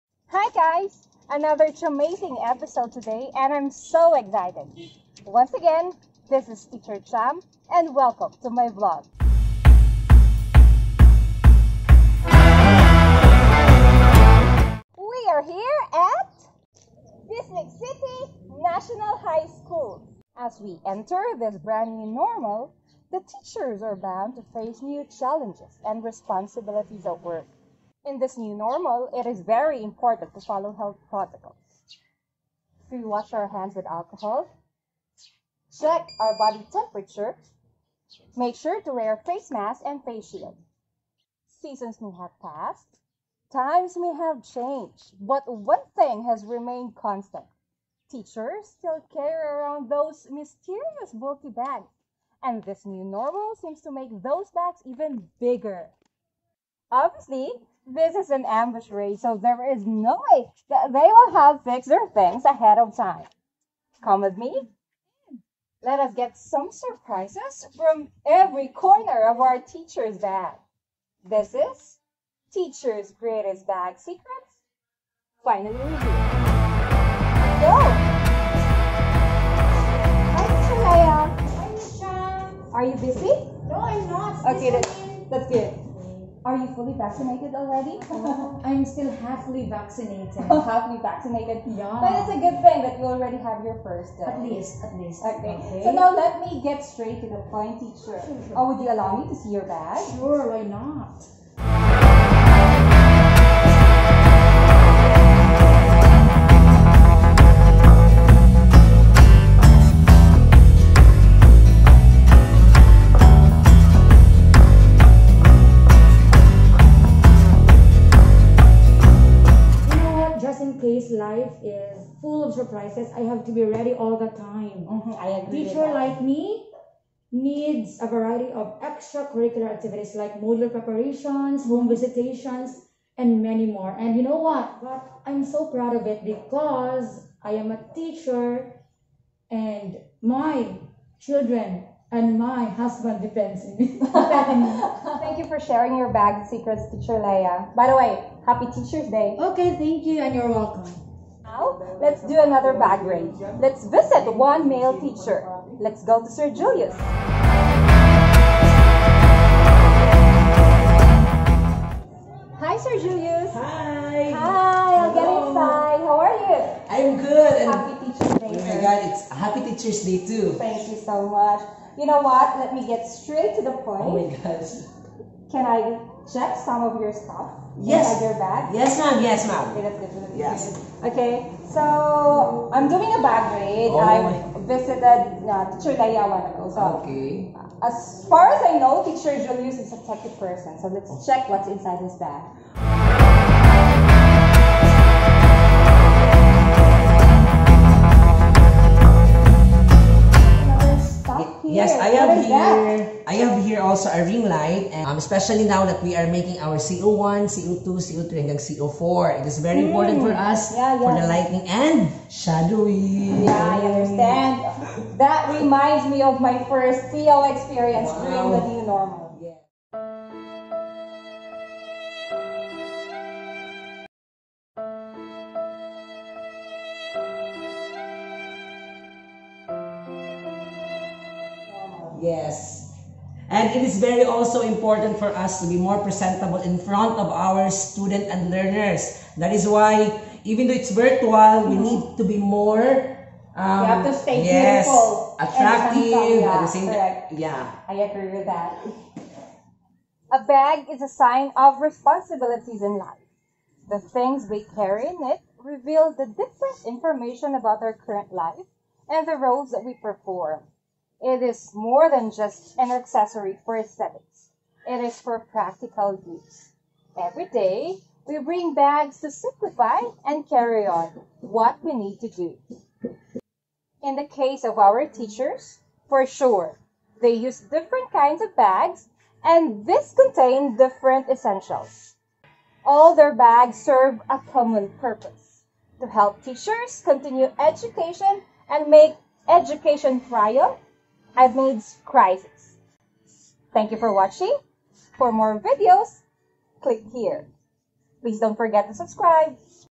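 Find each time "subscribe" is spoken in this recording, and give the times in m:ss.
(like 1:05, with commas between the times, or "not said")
4:58.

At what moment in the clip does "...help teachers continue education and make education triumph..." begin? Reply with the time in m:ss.
4:46.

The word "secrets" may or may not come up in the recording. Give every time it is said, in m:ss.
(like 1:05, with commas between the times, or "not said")
1:13, 2:26.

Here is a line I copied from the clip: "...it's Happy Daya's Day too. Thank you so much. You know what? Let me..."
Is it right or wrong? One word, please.
wrong.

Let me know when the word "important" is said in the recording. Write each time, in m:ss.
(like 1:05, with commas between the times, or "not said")
0:29, 3:29, 3:54.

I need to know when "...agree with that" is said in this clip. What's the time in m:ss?
4:08.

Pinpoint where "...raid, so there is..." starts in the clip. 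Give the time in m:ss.
0:58.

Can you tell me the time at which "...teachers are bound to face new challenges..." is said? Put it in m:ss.
0:23.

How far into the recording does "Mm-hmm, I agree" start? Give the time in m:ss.
2:04.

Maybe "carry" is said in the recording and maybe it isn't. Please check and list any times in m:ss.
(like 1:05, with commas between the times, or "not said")
0:49, 4:14, 4:30.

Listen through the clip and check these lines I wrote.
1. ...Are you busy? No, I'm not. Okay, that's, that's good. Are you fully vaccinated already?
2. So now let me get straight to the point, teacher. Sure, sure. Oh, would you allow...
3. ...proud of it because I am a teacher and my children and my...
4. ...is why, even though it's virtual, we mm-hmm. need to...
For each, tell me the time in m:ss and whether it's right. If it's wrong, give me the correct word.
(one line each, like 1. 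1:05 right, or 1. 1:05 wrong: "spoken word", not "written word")
1. 1:22 right
2. 1:35 right
3. 2:15 right
4. 3:59 right.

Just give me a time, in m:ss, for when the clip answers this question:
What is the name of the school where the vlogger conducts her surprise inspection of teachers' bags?
0:17.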